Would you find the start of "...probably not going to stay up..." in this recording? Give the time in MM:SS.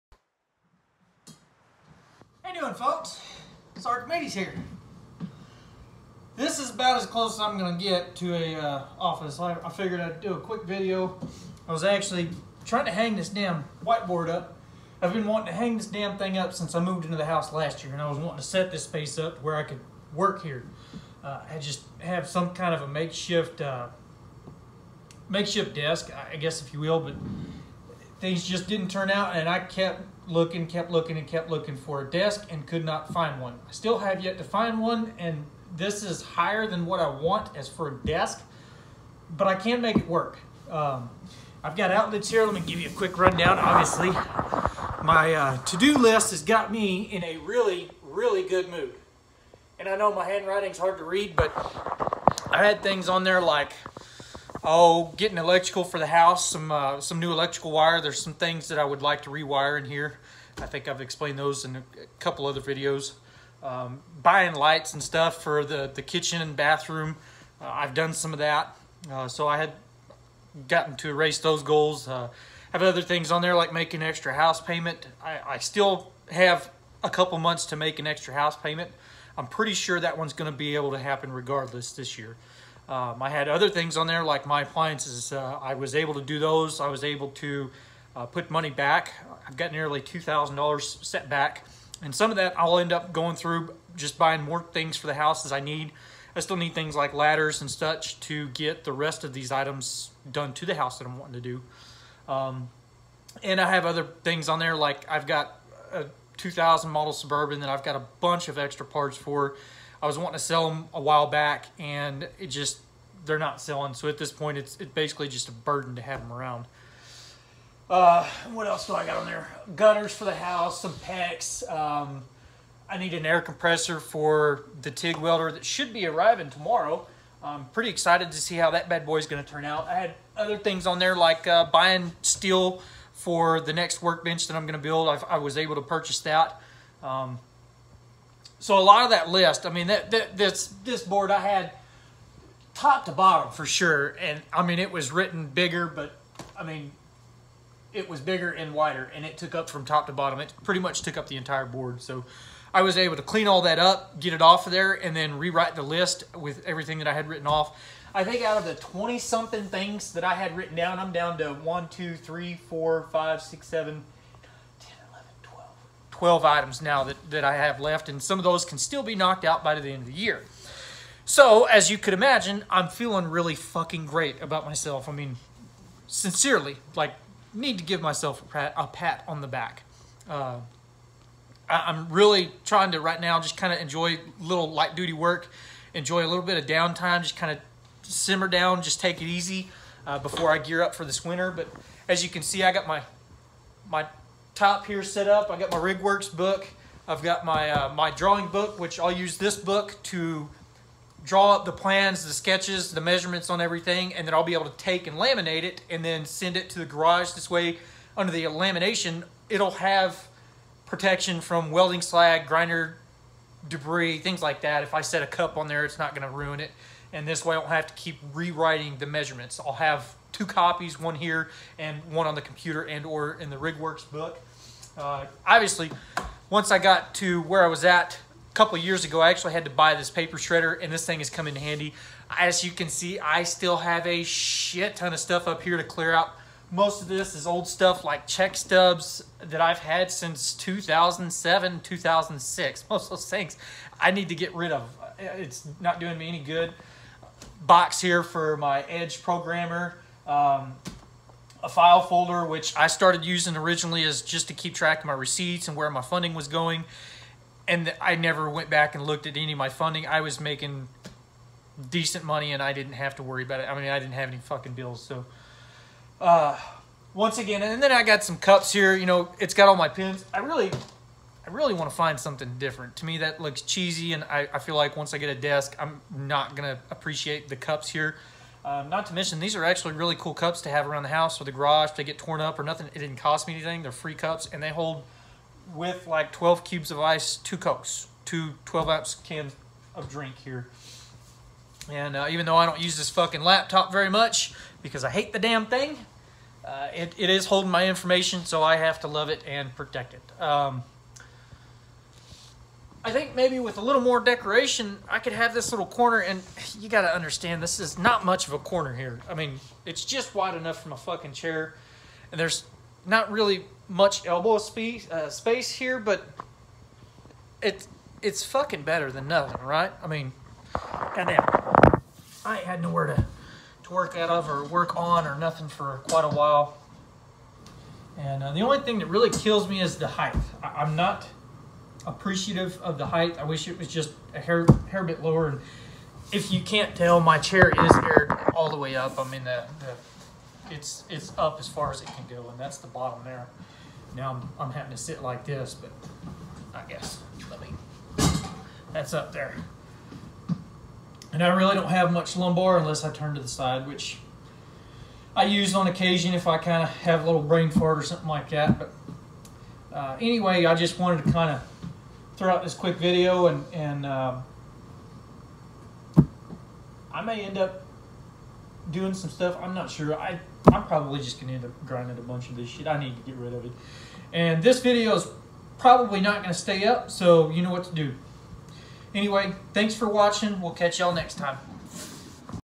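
06:15.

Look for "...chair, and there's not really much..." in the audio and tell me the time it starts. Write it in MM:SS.
05:11.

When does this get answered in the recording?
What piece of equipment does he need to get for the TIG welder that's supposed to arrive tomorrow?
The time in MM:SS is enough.
02:03.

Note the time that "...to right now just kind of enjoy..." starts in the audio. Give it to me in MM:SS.
03:02.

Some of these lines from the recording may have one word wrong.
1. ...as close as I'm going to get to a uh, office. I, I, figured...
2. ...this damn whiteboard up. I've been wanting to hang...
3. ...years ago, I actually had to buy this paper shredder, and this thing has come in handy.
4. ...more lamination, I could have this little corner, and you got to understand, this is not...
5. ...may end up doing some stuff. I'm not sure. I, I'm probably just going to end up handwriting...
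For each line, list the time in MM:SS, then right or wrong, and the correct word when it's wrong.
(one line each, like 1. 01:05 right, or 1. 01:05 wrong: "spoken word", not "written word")
1. 00:07 right
2. 00:13 right
3. 03:48 right
4. 05:04 wrong: "decoration", not "lamination"
5. 06:07 wrong: "grinding", not "handwriting".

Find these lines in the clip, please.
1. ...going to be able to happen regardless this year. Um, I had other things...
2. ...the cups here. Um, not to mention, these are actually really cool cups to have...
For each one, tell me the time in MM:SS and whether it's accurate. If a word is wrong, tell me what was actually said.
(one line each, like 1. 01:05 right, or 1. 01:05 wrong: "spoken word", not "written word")
1. 01:20 right
2. 04:37 right.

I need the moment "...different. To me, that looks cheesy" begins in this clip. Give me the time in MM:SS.
04:32.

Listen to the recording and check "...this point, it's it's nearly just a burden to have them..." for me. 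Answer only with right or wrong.
wrong.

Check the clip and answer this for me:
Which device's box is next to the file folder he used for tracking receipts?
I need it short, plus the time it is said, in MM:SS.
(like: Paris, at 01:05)
Edge programmer, at 04:08.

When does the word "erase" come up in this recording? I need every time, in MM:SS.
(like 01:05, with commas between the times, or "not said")
01:11.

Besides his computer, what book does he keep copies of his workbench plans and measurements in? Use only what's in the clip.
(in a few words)
RigWorks book.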